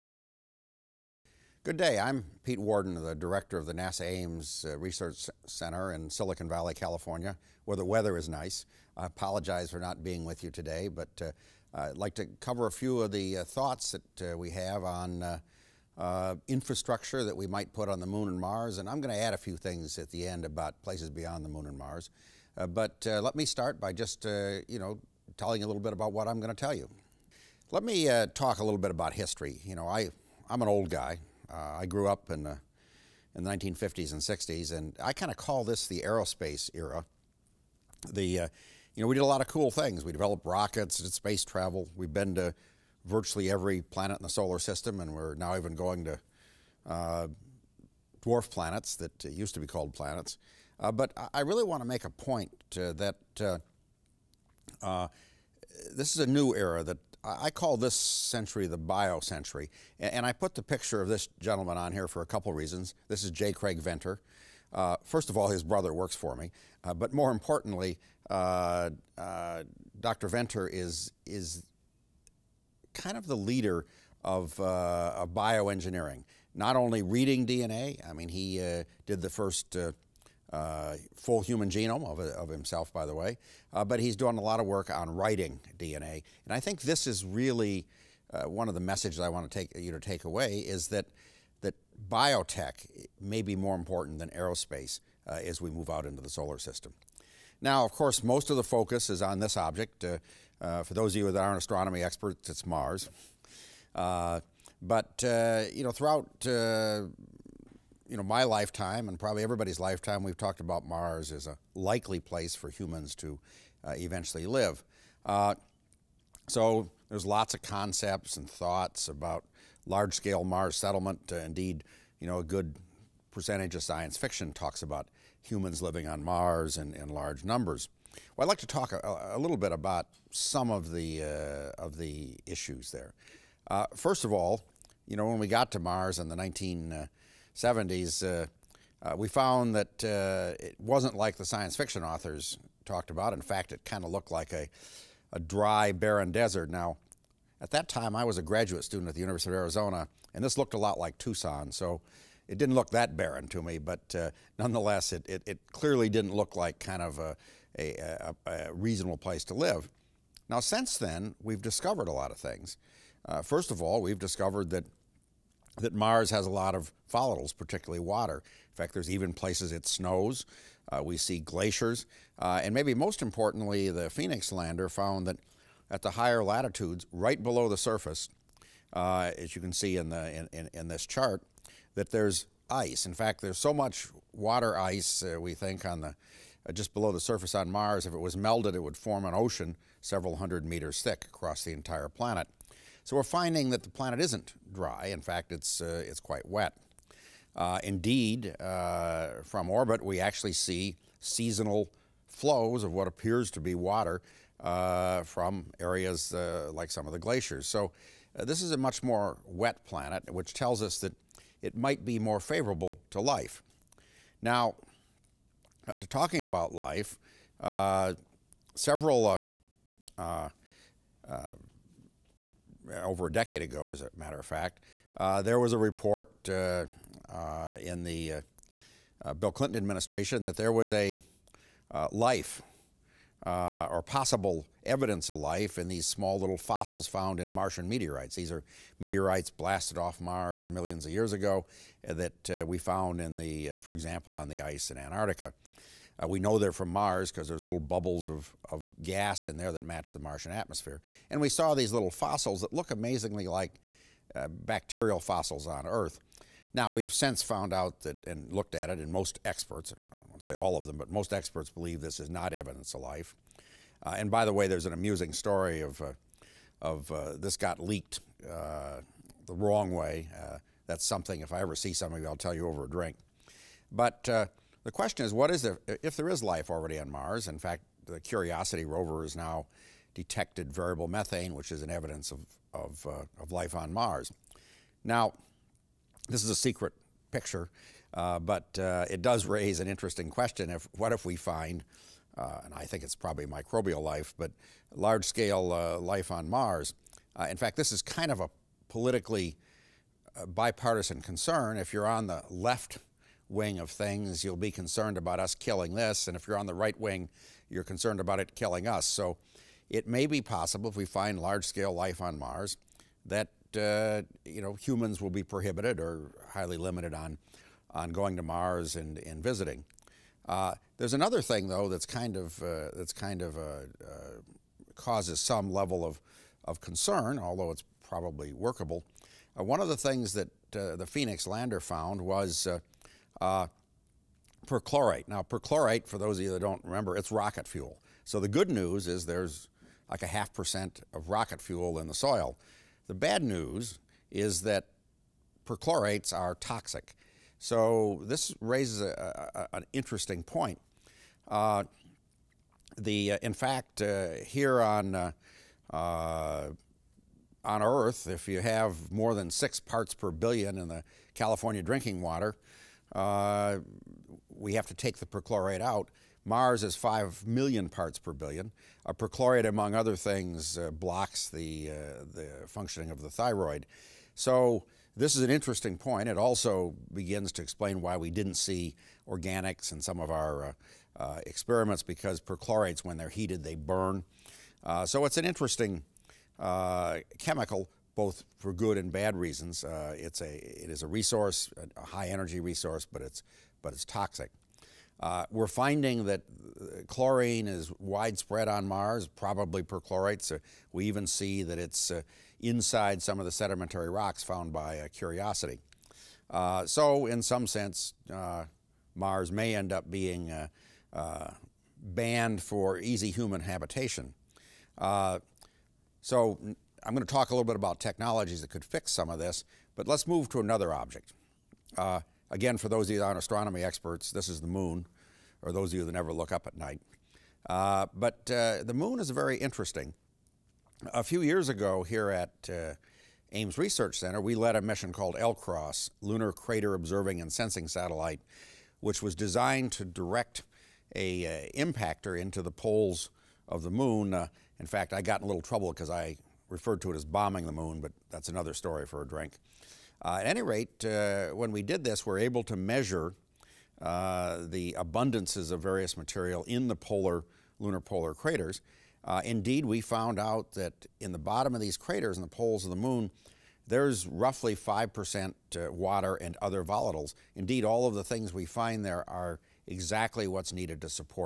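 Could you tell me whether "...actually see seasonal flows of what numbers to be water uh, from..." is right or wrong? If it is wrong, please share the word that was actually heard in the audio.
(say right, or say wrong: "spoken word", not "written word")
wrong: "appears", not "numbers".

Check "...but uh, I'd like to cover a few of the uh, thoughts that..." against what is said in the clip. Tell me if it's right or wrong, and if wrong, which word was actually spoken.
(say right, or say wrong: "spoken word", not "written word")
right.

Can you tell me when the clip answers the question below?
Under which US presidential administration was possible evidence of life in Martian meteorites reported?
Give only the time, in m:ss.
3:49.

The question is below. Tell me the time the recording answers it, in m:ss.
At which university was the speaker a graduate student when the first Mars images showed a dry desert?
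2:29.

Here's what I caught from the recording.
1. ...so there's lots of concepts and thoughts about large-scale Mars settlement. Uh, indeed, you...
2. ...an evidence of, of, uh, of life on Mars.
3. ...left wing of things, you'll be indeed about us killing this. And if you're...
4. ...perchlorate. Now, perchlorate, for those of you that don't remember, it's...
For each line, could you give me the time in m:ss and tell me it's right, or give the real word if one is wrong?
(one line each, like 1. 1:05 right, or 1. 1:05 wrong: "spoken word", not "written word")
1. 1:56 right
2. 4:41 right
3. 5:02 wrong: "concerned", not "indeed"
4. 5:34 right.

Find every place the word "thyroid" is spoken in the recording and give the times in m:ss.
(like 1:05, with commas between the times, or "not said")
6:13.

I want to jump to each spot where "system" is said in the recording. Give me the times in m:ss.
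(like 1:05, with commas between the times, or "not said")
0:44, 1:36.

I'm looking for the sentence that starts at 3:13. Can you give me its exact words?
So we're finding that the planet isn't dry.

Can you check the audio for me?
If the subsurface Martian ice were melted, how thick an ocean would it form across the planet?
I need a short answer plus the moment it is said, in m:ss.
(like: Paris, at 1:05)
several hundred meters, at 3:09.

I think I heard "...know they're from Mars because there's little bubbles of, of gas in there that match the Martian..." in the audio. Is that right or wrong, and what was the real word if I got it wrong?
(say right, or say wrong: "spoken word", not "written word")
right.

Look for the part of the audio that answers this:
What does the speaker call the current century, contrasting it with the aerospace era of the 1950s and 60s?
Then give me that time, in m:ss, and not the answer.
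0:58.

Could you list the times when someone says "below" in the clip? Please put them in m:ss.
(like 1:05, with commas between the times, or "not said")
2:57, 3:06.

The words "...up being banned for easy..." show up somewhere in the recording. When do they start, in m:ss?
6:49.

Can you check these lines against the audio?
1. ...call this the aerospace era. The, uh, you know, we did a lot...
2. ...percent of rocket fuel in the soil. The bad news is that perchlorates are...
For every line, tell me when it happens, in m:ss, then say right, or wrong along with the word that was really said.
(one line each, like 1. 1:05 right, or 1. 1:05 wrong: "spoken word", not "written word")
1. 0:35 right
2. 5:40 right.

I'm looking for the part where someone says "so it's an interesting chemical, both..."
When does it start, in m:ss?
6:25.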